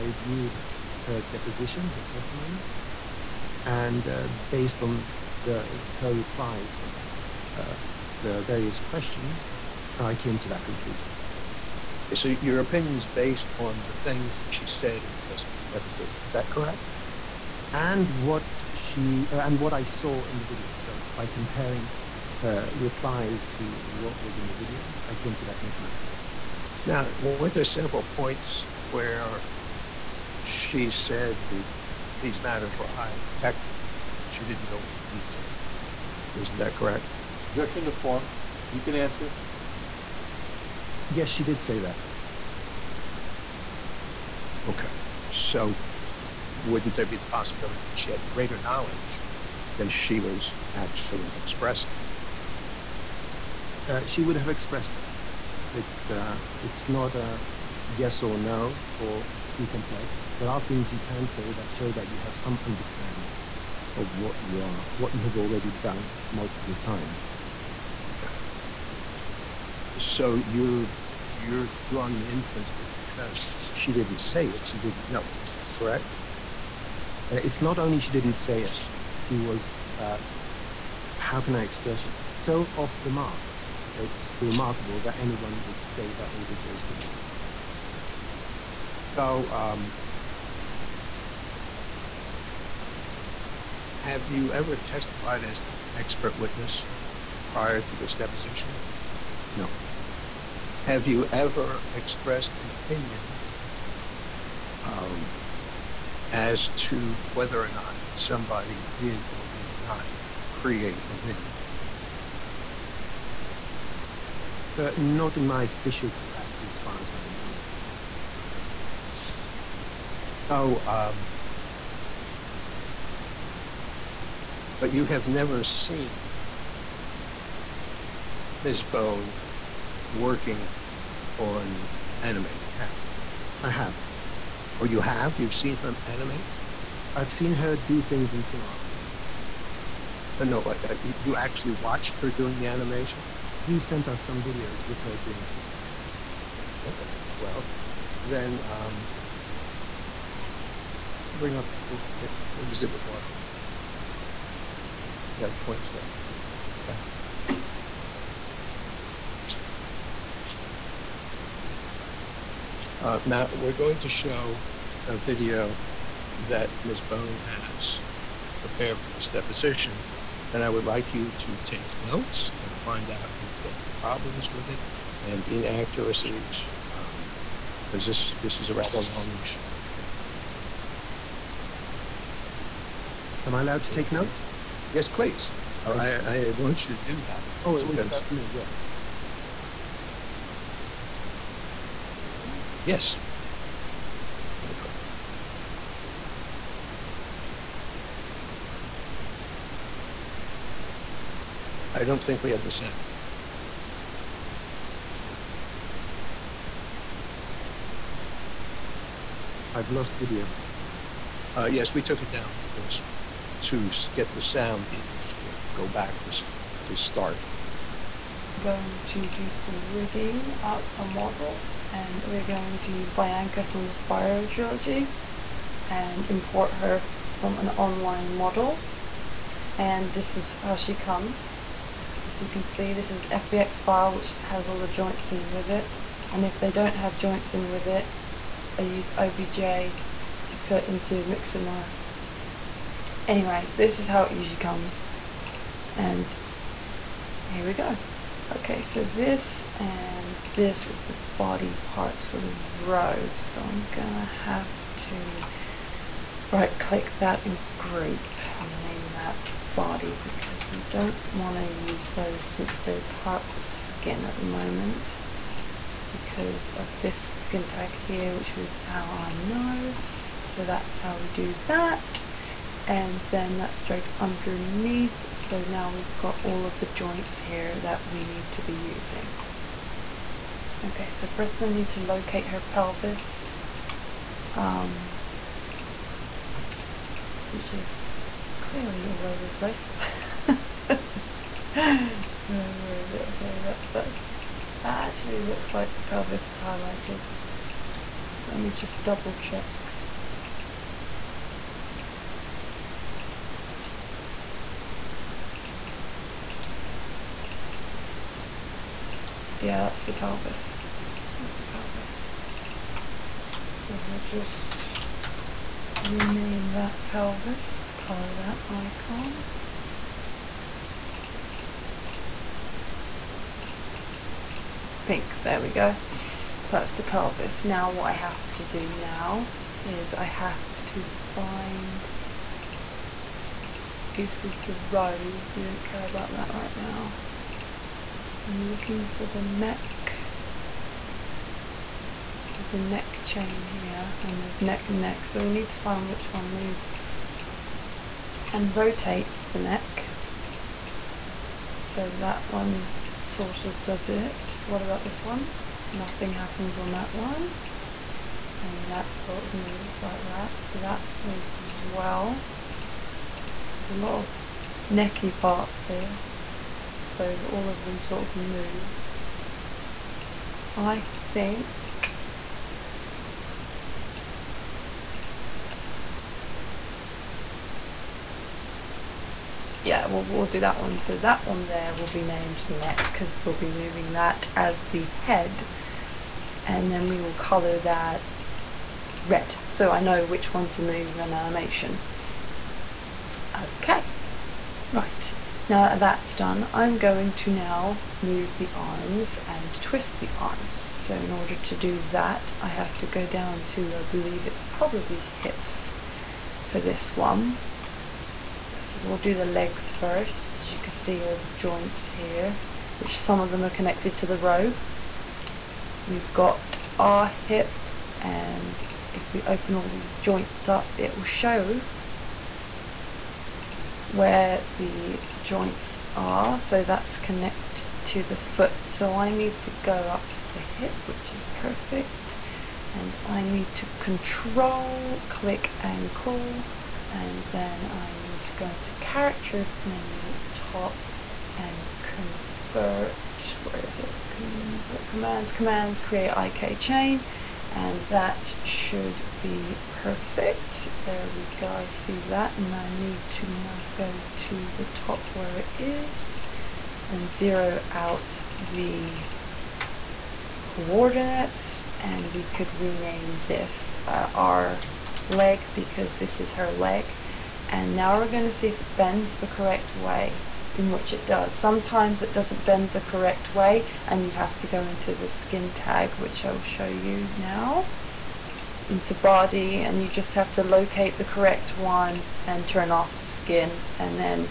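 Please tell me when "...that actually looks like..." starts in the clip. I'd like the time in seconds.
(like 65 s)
294 s.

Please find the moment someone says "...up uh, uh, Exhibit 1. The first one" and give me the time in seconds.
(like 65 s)
151 s.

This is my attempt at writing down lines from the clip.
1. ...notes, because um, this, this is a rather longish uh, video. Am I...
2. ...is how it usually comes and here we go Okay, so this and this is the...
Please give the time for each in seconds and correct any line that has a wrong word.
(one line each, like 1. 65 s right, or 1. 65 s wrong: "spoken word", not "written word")
1. 175 s wrong: "inaccuracies", not "notes"
2. 243 s right.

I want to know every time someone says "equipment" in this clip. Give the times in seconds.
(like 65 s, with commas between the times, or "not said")
not said.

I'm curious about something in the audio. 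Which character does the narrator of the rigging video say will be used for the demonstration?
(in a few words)
Bianca.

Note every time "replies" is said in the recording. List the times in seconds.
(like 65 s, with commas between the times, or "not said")
6 s, 22 s.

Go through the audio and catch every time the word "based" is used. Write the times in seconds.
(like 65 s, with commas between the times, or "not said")
4 s, 13 s.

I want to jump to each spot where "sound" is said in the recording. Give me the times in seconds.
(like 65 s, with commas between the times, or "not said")
202 s, 214 s.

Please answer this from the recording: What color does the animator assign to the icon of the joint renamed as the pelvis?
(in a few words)
Pink.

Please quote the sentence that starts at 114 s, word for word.
Uh, not in my official capacity, as far as I remember.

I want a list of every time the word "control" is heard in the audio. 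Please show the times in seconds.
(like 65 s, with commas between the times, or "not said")
433 s.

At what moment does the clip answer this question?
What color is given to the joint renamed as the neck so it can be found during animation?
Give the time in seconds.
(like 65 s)
389 s.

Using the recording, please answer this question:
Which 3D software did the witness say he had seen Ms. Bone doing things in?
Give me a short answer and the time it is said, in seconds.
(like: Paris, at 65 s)
Cinema 4D, at 138 s.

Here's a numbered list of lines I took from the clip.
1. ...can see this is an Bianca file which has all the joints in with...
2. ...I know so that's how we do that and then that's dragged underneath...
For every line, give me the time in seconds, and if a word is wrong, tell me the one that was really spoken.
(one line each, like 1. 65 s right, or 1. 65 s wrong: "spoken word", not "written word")
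1. 232 s wrong: "FBX", not "Bianca"
2. 269 s right.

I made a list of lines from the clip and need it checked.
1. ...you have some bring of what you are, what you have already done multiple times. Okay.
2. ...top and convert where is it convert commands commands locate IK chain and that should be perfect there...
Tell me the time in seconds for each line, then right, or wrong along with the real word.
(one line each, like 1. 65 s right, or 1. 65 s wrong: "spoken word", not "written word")
1. 62 s wrong: "understanding", not "bring"
2. 440 s wrong: "create", not "locate".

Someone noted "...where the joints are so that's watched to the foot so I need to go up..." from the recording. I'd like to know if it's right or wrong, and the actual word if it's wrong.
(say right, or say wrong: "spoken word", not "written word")
wrong: "connected", not "watched".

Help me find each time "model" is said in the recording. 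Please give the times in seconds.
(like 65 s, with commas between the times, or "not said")
221 s, 228 s.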